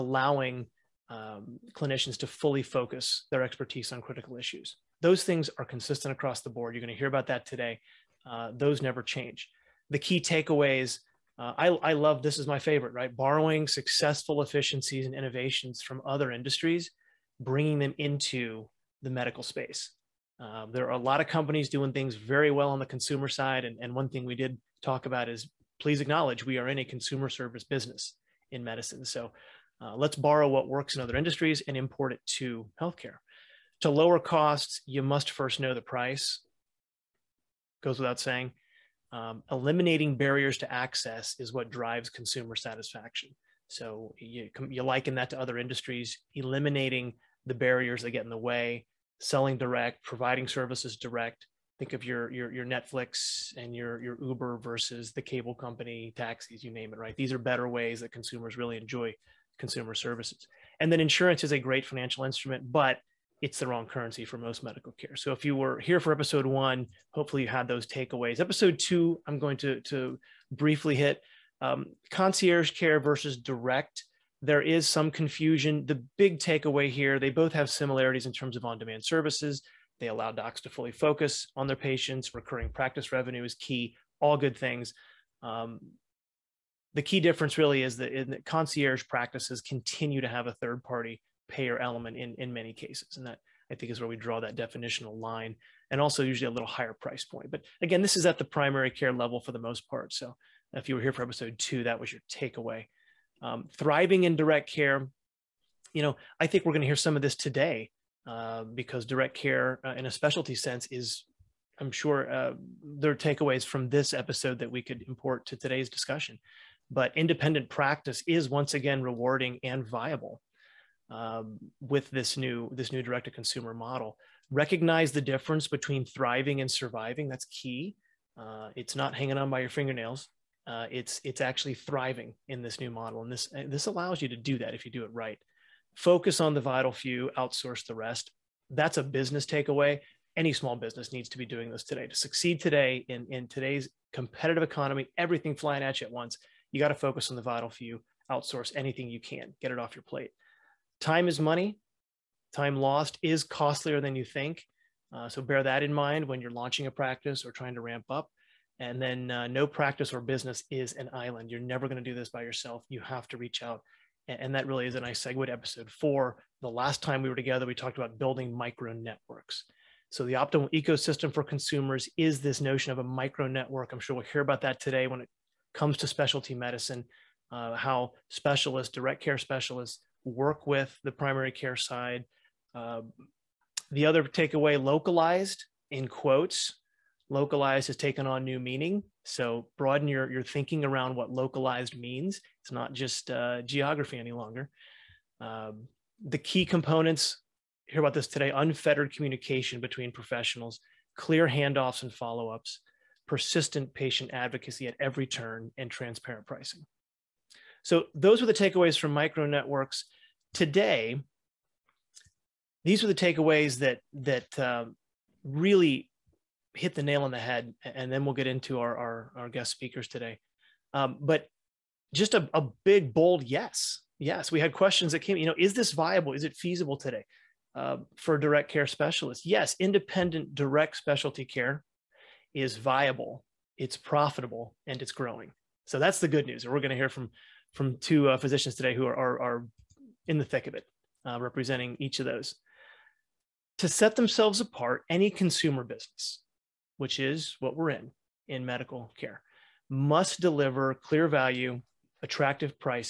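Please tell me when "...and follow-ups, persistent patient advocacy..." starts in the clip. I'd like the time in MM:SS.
03:22.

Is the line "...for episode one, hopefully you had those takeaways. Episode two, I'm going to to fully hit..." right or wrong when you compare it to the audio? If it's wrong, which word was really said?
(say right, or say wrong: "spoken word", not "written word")
wrong: "briefly", not "fully".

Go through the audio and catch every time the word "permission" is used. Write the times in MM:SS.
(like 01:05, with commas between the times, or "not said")
not said.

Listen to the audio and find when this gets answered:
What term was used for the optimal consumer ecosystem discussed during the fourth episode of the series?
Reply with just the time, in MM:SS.
02:53.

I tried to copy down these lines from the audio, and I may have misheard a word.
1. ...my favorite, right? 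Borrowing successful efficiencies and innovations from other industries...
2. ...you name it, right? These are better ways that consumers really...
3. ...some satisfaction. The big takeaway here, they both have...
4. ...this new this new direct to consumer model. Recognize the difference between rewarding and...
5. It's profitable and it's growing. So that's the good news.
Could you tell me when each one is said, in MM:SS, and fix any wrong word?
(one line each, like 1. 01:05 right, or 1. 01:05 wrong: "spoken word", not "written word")
1. 00:12 right
2. 00:56 right
3. 01:14 wrong: "confusion", not "satisfaction"
4. 02:02 wrong: "thriving", not "rewarding"
5. 03:53 right.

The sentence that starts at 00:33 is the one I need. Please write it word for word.
To lower costs, you must first know the price.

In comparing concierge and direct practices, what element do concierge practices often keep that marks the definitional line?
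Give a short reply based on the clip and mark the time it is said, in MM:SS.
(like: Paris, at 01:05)
A third party payer, at 01:30.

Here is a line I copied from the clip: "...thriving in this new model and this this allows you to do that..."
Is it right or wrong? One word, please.
right.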